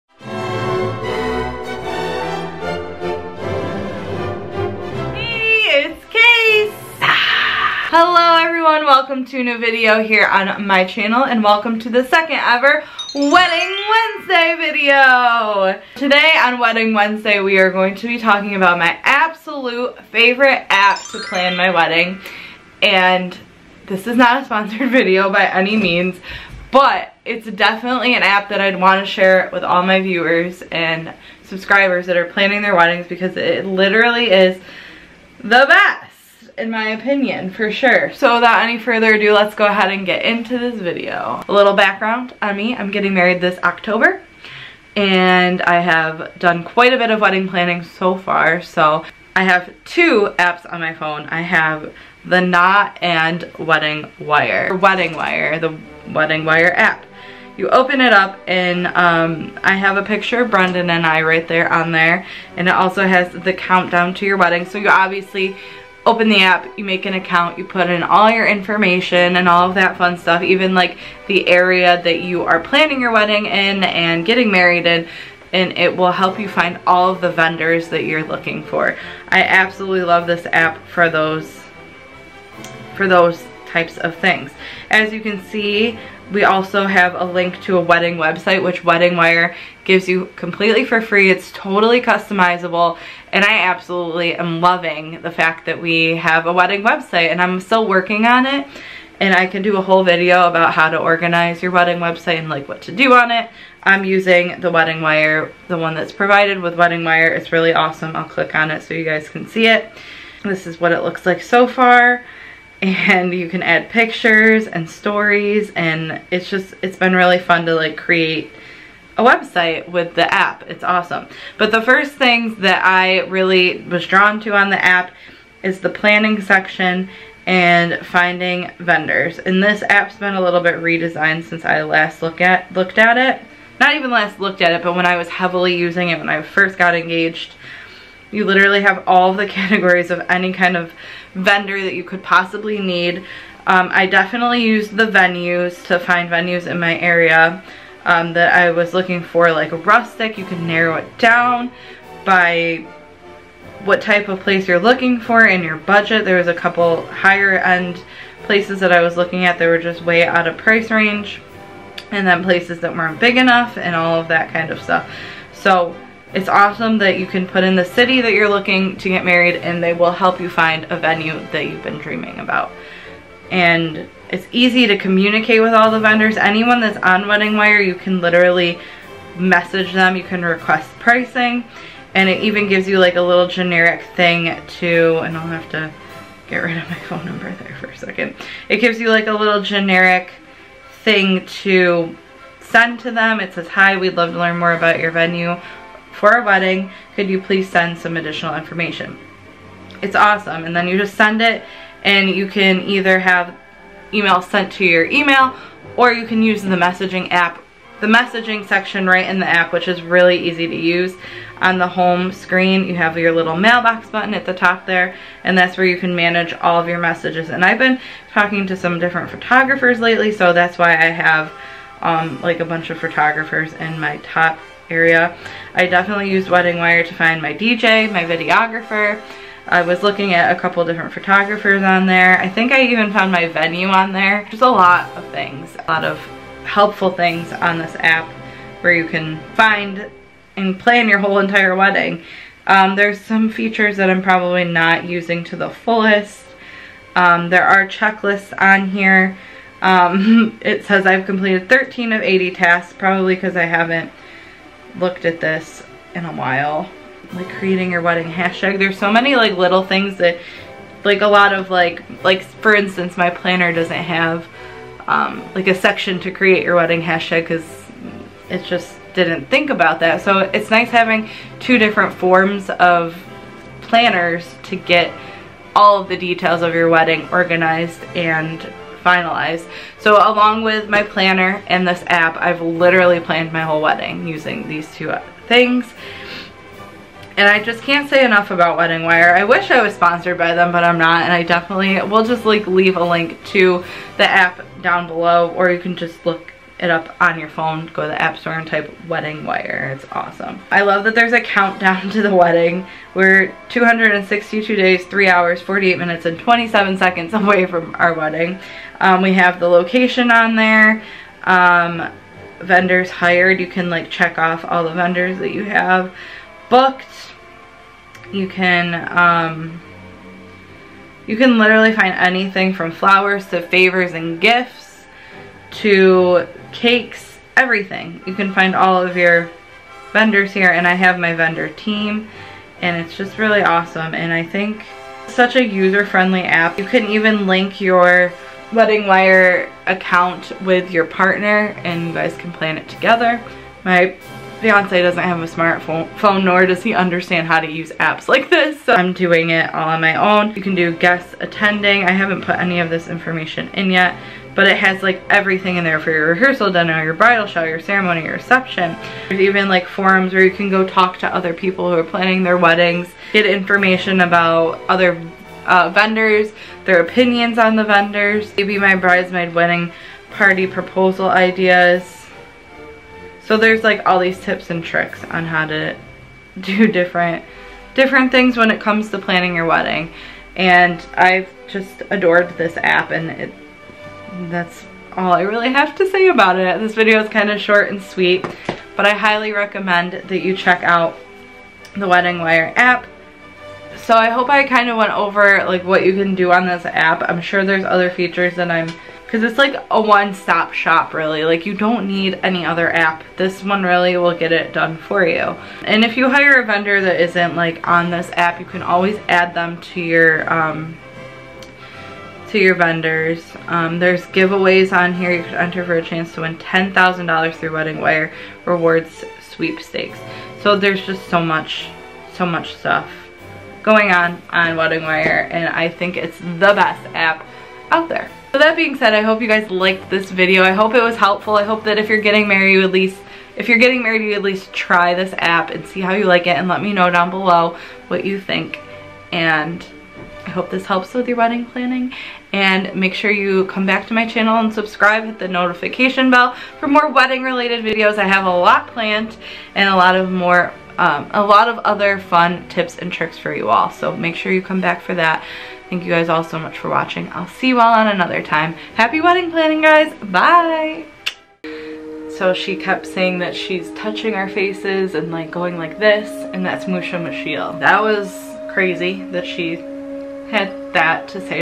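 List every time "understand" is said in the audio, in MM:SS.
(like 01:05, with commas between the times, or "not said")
05:46.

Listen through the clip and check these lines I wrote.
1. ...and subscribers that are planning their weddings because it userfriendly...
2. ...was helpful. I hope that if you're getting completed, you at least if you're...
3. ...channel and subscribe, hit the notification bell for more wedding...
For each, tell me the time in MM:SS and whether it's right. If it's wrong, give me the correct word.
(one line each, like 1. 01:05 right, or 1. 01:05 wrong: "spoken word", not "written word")
1. 00:30 wrong: "literally", not "userfriendly"
2. 07:11 wrong: "married", not "completed"
3. 07:24 right.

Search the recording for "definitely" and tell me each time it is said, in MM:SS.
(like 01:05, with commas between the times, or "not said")
00:27, 02:24, 03:45, 04:51.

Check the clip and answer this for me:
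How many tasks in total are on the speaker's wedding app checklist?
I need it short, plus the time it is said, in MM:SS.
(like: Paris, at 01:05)
80, at 04:12.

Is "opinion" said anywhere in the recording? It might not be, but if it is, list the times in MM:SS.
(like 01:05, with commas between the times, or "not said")
00:36, 06:07.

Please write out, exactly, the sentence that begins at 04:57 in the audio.
Go to the app store and type Wedding Wire.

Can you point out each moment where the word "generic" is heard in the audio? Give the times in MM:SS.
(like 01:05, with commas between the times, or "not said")
03:03, 03:09.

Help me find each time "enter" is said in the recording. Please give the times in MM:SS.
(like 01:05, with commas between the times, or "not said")
06:55.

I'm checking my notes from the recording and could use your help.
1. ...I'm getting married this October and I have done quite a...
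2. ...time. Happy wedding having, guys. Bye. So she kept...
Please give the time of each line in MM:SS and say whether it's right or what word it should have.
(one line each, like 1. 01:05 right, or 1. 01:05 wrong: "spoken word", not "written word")
1. 00:42 right
2. 07:38 wrong: "planning", not "having".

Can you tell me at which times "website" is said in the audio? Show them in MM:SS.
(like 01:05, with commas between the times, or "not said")
01:28, 01:36, 01:41, 01:59.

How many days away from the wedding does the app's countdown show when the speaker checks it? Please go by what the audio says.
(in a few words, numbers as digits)
262.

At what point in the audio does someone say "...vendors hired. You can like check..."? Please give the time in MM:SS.
05:12.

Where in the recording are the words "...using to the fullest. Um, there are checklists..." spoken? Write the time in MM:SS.
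04:05.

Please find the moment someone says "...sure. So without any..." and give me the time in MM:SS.
00:37.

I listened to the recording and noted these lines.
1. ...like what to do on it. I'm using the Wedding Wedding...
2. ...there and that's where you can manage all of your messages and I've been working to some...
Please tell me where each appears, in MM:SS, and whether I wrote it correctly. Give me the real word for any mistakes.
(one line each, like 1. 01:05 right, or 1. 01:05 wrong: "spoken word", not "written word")
1. 01:42 wrong: "Wire", not "Wedding"
2. 03:34 wrong: "talking", not "working".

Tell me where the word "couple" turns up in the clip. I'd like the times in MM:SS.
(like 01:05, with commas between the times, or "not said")
02:36, 03:50.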